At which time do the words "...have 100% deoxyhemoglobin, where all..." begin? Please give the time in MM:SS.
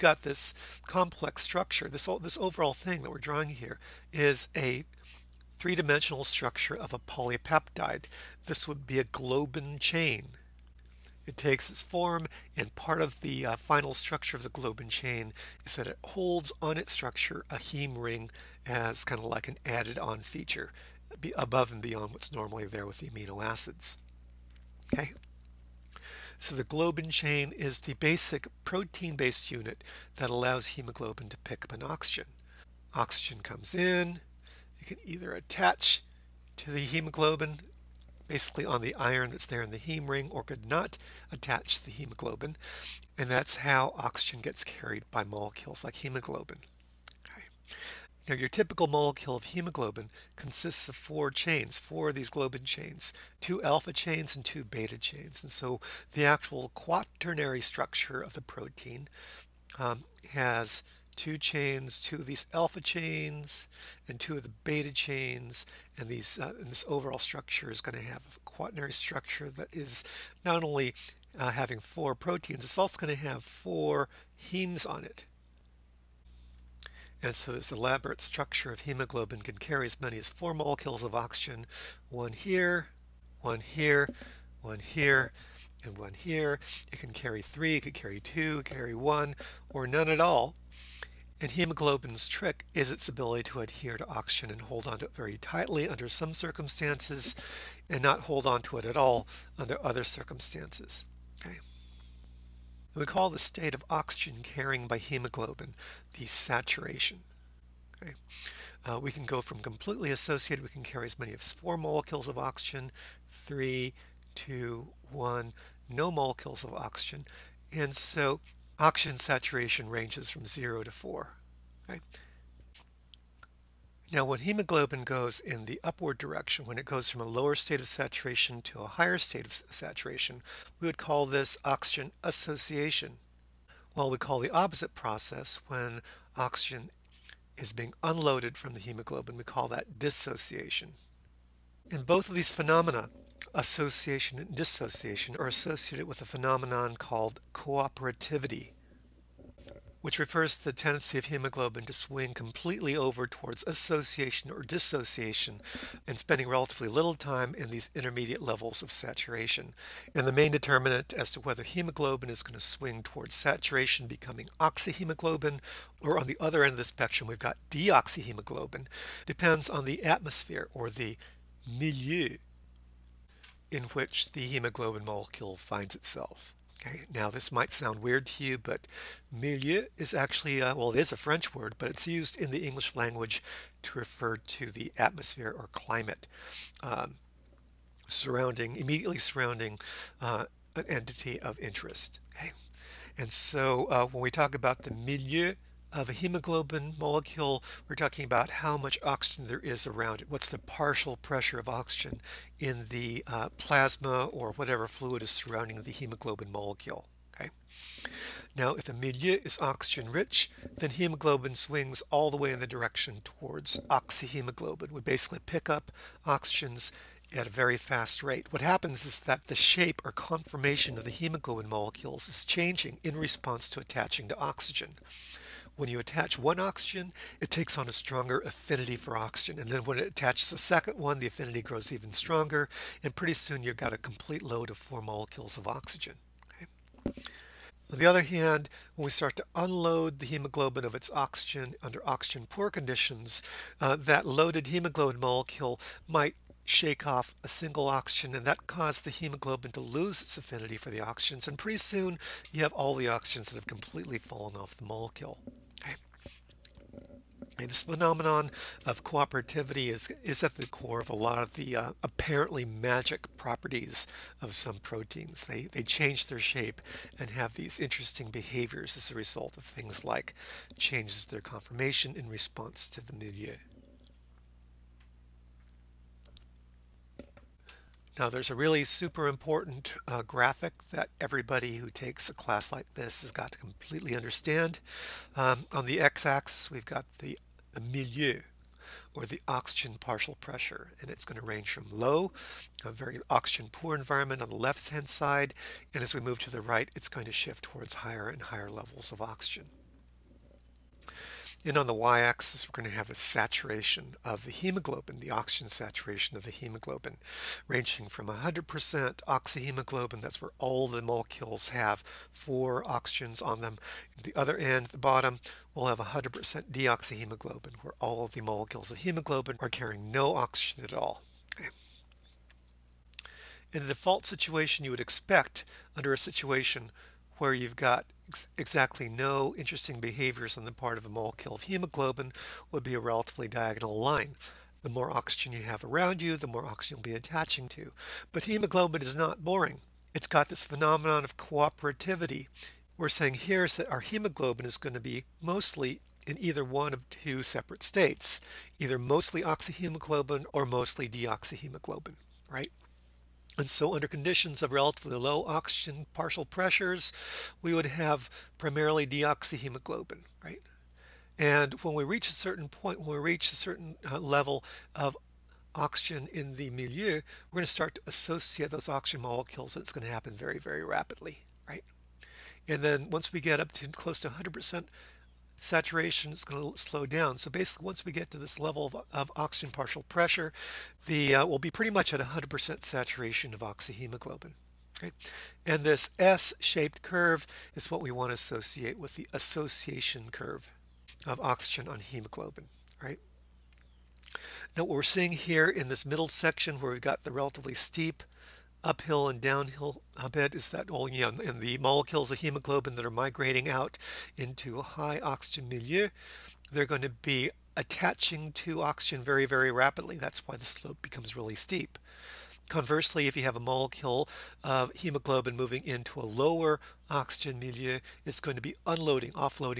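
05:15.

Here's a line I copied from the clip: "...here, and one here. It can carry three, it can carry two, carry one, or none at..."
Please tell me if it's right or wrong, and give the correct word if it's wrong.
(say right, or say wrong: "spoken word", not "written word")
right.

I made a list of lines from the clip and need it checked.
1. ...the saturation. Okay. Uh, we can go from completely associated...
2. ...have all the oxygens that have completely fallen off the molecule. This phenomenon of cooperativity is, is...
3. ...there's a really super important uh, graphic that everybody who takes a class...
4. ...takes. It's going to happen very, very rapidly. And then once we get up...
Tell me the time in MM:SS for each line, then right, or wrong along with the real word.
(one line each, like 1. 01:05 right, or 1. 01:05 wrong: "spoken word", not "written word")
1. 01:46 right
2. 04:12 right
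3. 04:38 right
4. 06:09 wrong: "molecules", not "takes".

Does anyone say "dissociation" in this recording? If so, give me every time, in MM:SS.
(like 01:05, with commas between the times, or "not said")
02:19, 02:24, 02:34.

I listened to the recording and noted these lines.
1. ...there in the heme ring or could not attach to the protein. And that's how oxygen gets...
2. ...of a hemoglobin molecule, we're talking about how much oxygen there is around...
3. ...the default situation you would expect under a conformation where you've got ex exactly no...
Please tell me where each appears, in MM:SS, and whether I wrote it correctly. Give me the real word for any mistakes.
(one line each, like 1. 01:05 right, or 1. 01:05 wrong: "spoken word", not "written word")
1. 00:39 wrong: "hemoglobin", not "protein"
2. 03:15 right
3. 05:23 wrong: "situation", not "conformation".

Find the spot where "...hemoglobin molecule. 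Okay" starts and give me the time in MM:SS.
03:25.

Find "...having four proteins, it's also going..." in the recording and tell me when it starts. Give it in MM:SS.
01:11.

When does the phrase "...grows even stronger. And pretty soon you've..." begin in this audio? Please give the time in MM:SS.
03:51.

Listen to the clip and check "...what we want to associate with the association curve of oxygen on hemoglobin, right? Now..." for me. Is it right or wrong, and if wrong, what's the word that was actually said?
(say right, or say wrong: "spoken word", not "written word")
right.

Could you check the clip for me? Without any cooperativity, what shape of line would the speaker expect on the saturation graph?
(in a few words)
diagonal line.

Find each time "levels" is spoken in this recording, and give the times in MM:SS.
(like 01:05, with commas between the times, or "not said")
02:38, 04:58, 06:04, 06:18.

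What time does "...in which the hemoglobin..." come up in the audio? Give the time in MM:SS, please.
02:53.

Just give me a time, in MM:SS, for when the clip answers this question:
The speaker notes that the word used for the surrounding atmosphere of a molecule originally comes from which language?
03:01.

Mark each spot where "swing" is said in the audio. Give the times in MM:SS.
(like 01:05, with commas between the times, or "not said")
02:31, 02:42, 03:31.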